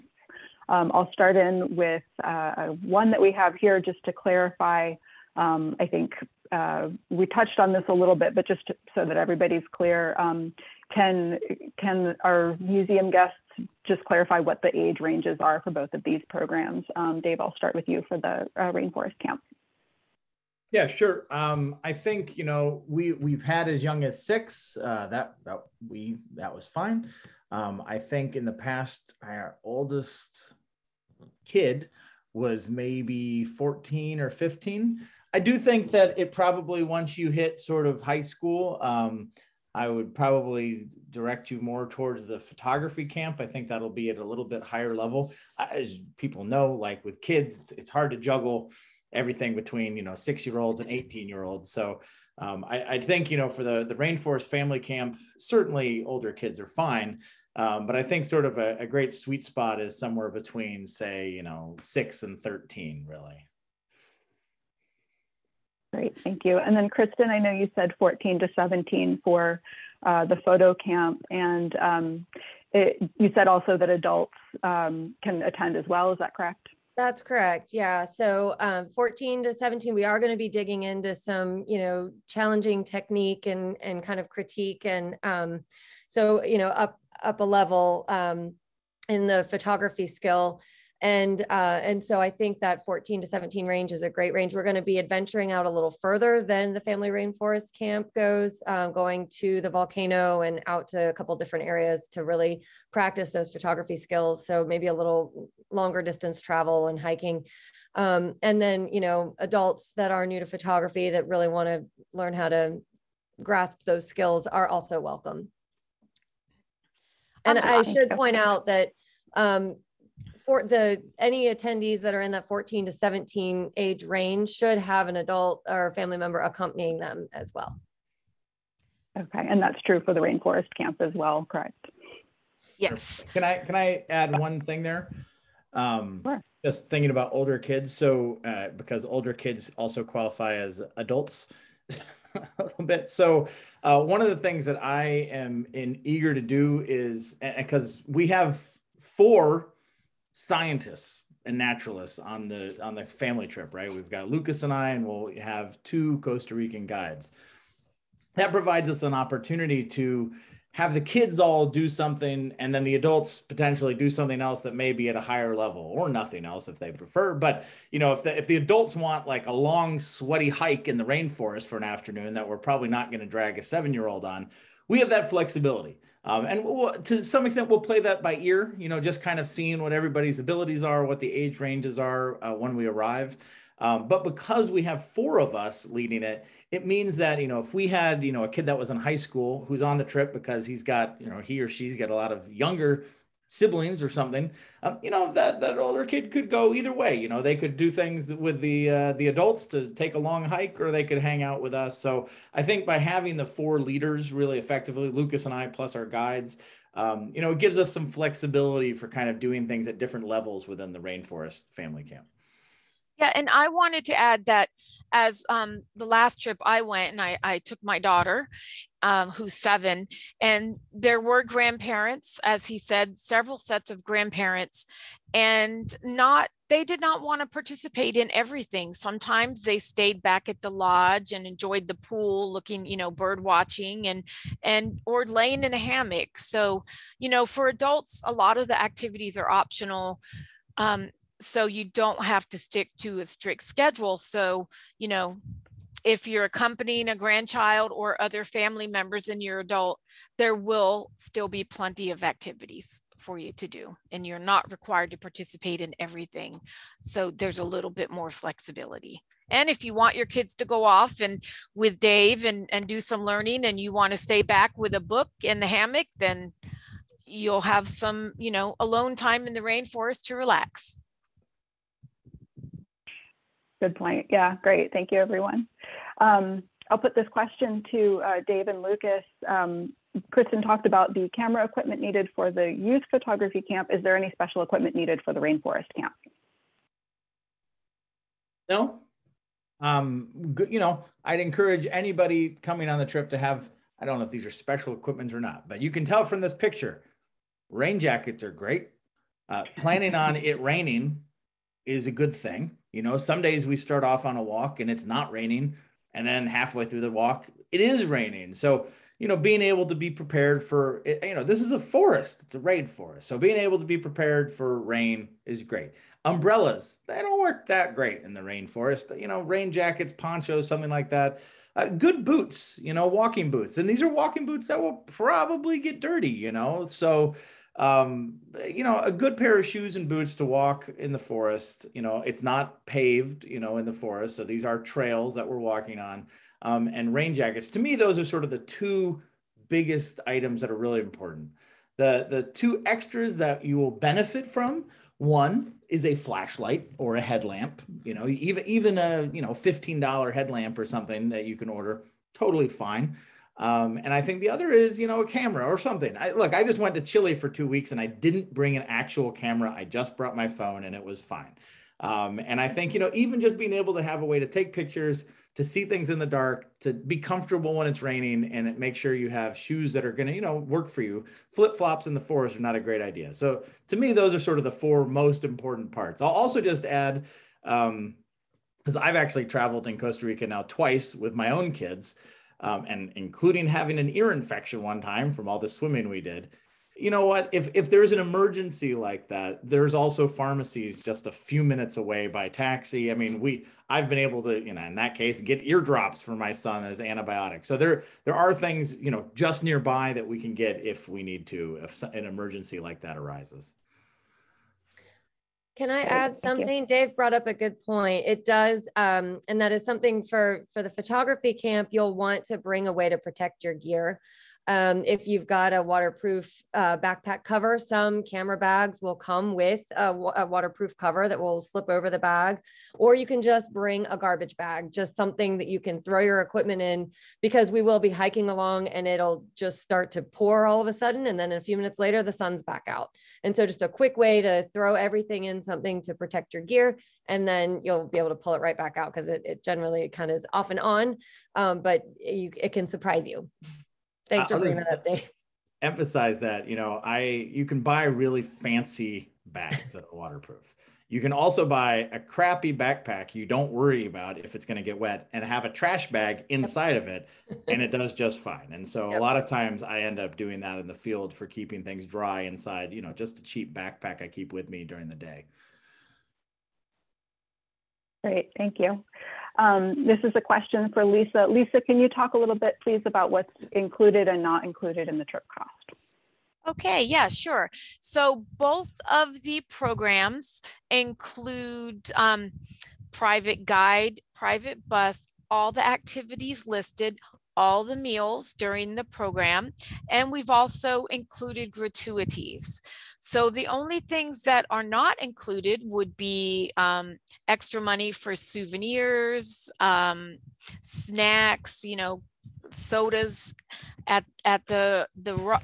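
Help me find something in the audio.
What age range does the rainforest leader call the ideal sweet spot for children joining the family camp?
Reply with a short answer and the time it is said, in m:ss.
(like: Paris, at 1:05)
6 to 13, at 1:01.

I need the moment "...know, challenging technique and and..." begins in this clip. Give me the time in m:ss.
1:21.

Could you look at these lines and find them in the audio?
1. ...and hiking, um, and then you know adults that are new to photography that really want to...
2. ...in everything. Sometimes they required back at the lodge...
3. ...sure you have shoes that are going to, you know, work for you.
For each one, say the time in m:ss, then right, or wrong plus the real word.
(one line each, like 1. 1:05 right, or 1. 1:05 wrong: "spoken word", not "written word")
1. 1:46 right
2. 3:48 wrong: "stayed", not "required"
3. 6:08 right.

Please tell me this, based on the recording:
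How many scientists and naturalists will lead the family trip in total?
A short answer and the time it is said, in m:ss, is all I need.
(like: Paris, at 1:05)
4, at 2:28.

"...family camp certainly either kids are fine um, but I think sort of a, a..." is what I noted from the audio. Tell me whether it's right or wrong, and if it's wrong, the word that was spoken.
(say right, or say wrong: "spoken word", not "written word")
wrong: "older", not "either".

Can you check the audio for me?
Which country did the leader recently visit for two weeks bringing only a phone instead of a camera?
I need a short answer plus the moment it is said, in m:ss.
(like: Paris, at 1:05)
Chile, at 5:57.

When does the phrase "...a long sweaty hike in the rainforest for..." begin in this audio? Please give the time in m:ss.
2:49.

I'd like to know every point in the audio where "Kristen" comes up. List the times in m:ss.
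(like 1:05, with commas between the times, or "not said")
1:06, 4:40.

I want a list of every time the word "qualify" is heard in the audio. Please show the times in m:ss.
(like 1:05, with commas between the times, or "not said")
2:20.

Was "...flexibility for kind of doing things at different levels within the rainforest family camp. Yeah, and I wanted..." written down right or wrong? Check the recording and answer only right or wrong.
right.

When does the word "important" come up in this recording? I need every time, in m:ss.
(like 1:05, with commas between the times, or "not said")
5:40, 6:15.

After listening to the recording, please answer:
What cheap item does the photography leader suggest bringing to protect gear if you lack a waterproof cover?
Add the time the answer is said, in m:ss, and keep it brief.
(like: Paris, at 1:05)
garbage bag, at 7:04.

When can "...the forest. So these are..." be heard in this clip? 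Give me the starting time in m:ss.
5:33.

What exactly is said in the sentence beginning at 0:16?
Um, Dave, I'll start with you for the uh, rainforest camp.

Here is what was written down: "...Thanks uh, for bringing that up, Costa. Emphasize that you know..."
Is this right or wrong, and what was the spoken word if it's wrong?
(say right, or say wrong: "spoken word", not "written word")
wrong: "Dave", not "Costa".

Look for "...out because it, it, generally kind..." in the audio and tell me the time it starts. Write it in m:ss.
7:18.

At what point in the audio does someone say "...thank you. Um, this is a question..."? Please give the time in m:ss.
7:48.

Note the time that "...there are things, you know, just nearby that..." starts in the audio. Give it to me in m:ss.
6:38.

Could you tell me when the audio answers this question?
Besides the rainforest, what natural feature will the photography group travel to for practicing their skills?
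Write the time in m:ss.
1:39.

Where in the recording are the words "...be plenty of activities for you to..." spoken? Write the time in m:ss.
4:11.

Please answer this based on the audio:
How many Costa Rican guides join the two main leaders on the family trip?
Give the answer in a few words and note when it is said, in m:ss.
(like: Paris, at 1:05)
2, at 2:35.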